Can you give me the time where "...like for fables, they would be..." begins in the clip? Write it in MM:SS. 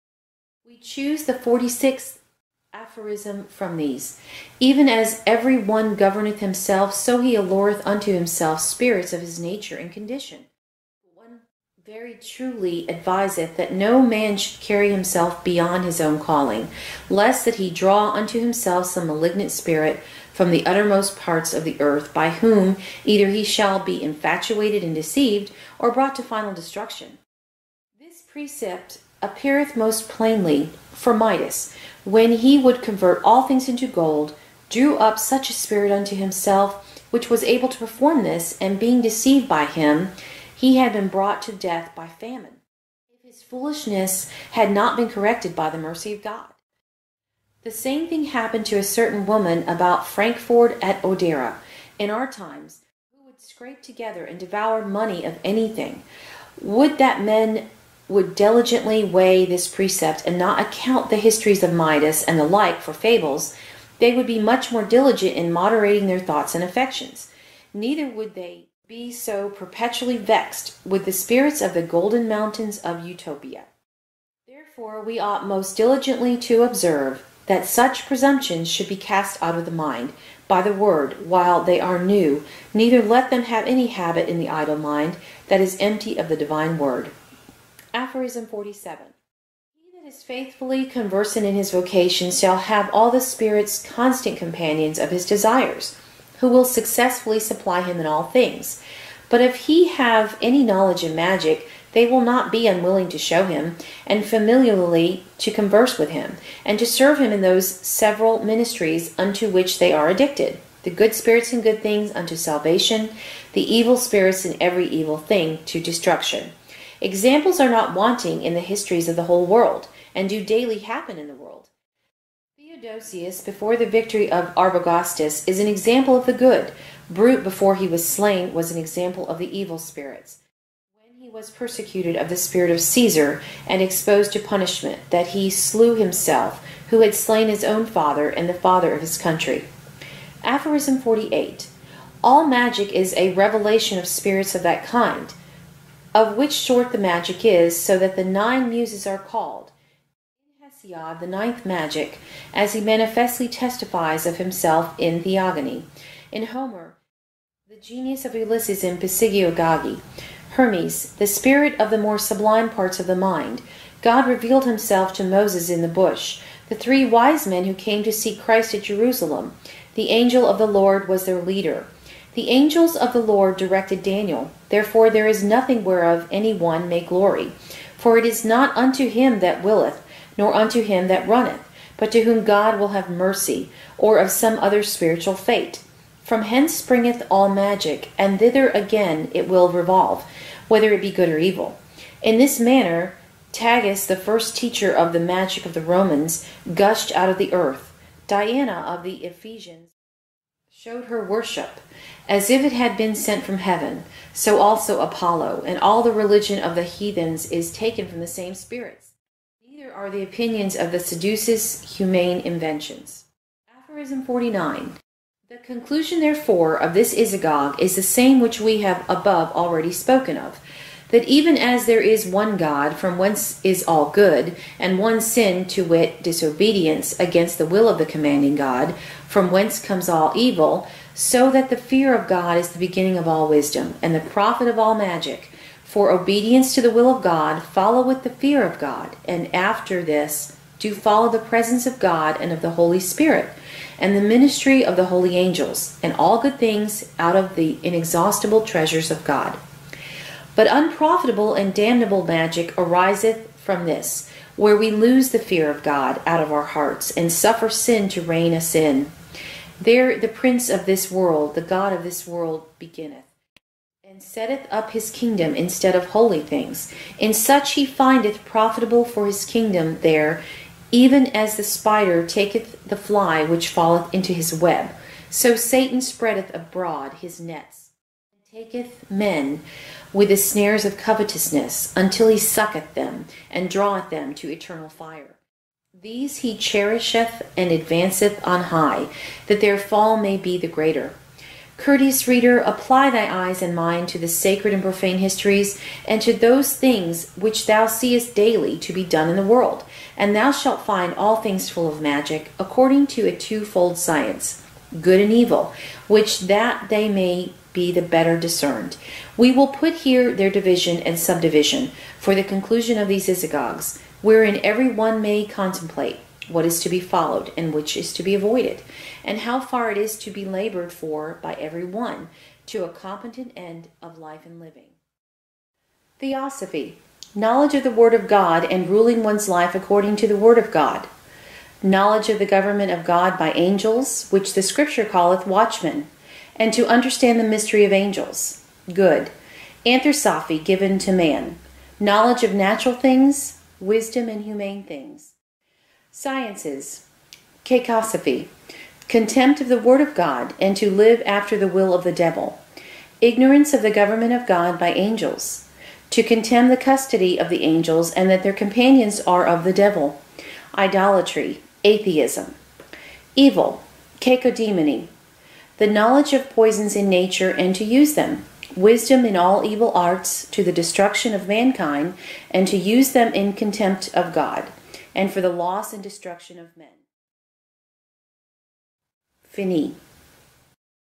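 01:02.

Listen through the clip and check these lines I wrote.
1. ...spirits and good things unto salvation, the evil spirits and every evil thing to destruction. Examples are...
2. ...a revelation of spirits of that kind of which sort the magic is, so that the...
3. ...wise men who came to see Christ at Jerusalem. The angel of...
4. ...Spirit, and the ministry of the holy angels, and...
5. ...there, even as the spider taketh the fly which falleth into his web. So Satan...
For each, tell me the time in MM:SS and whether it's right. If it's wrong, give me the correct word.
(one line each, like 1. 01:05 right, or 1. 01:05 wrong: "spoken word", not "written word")
1. 01:51 right
2. 02:23 right
3. 02:47 right
4. 04:03 right
5. 04:30 right.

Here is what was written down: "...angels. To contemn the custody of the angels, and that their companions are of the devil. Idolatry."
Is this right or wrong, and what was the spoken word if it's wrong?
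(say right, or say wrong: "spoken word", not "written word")
right.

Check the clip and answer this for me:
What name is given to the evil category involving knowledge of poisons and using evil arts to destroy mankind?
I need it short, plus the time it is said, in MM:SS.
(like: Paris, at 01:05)
Cacodemony, at 06:04.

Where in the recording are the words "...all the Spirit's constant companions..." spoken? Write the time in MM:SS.
01:32.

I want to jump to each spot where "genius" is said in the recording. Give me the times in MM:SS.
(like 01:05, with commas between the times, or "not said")
02:37.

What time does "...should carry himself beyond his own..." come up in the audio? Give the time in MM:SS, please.
00:14.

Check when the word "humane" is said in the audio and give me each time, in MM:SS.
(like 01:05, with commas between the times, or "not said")
03:31, 05:44.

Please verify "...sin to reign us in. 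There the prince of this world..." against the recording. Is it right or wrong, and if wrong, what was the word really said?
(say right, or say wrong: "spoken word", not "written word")
right.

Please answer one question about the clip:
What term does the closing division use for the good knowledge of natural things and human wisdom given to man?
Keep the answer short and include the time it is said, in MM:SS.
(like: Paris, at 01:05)
Anthroposophy, at 05:39.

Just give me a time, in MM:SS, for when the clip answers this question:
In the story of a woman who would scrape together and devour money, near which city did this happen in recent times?
00:50.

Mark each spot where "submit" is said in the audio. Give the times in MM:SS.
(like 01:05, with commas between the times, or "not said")
not said.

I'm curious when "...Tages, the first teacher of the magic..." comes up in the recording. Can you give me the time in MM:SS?
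03:13.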